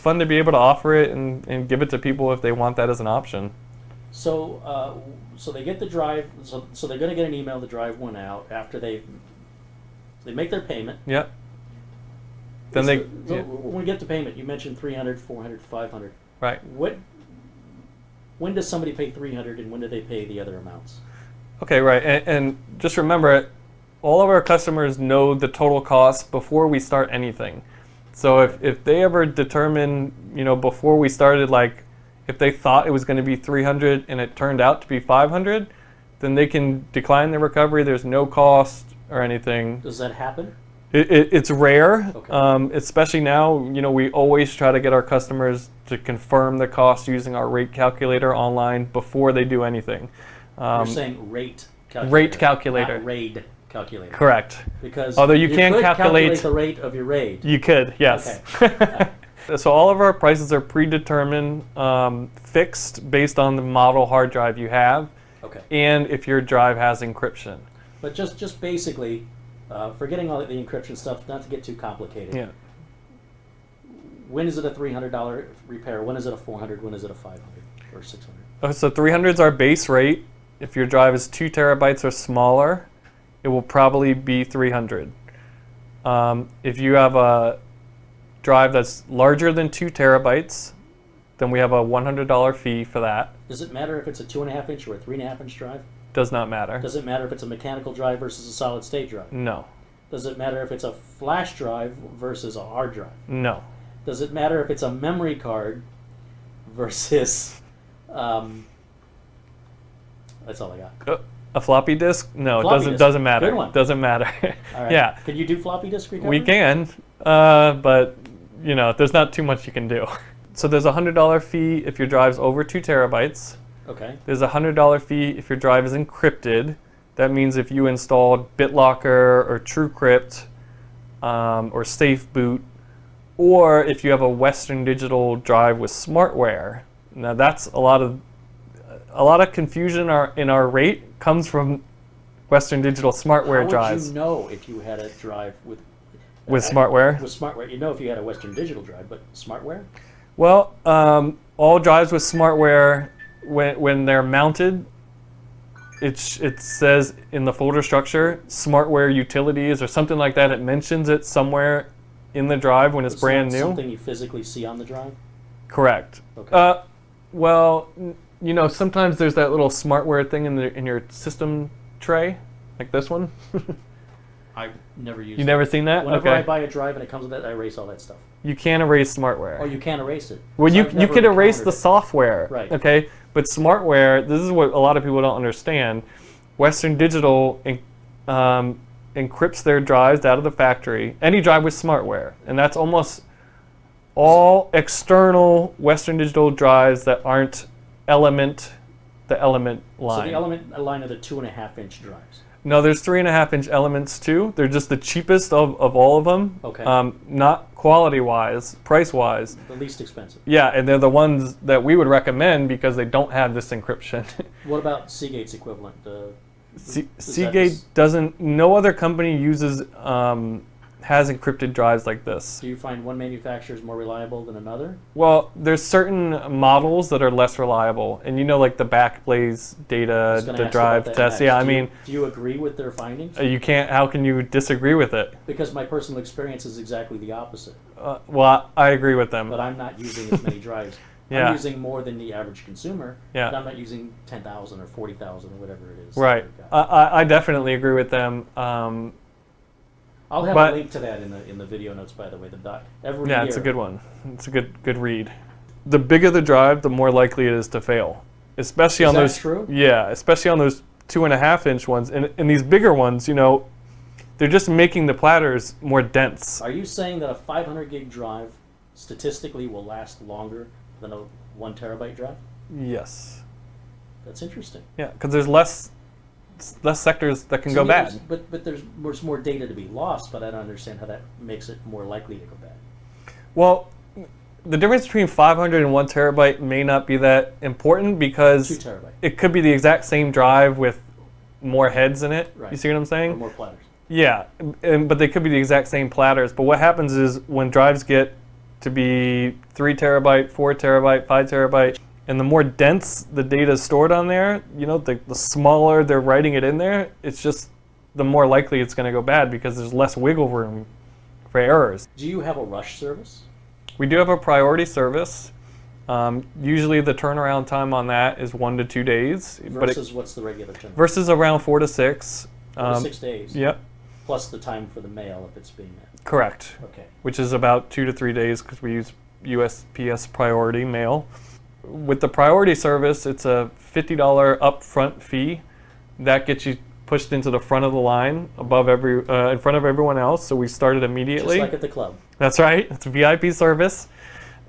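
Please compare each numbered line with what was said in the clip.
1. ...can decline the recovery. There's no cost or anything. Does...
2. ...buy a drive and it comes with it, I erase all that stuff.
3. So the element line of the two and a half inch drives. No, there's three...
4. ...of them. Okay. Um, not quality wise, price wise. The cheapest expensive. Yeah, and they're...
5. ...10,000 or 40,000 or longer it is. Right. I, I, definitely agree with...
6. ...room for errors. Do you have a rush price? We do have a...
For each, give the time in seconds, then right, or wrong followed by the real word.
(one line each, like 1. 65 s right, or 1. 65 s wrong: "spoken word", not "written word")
1. 36 s right
2. 176 s right
3. 200 s right
4. 206 s wrong: "least", not "cheapest"
5. 244 s wrong: "whatever", not "longer"
6. 310 s wrong: "service", not "price".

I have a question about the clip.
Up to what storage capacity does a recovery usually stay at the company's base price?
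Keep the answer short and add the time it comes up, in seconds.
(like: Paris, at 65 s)
2 terabytes, at 81 s.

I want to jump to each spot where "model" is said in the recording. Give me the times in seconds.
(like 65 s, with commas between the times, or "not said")
63 s, 226 s.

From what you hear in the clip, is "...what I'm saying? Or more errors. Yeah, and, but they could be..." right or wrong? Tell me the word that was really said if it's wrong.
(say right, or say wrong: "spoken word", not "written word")
wrong: "platters", not "errors".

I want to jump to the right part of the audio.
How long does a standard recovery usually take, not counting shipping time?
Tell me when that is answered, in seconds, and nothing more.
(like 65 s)
321 s.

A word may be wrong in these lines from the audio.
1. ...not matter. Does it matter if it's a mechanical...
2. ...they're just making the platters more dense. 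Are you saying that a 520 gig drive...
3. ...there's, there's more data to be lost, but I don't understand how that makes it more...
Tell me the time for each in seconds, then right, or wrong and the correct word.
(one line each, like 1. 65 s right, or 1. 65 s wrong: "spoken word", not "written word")
1. 96 s right
2. 264 s wrong: "500", not "520"
3. 278 s right.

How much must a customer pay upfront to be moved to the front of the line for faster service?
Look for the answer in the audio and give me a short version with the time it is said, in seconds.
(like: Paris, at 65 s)
$50, at 333 s.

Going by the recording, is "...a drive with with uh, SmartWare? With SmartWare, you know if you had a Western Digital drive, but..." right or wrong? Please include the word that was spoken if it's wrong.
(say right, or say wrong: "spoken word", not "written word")
right.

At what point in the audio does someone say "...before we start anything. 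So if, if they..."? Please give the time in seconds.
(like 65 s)
26 s.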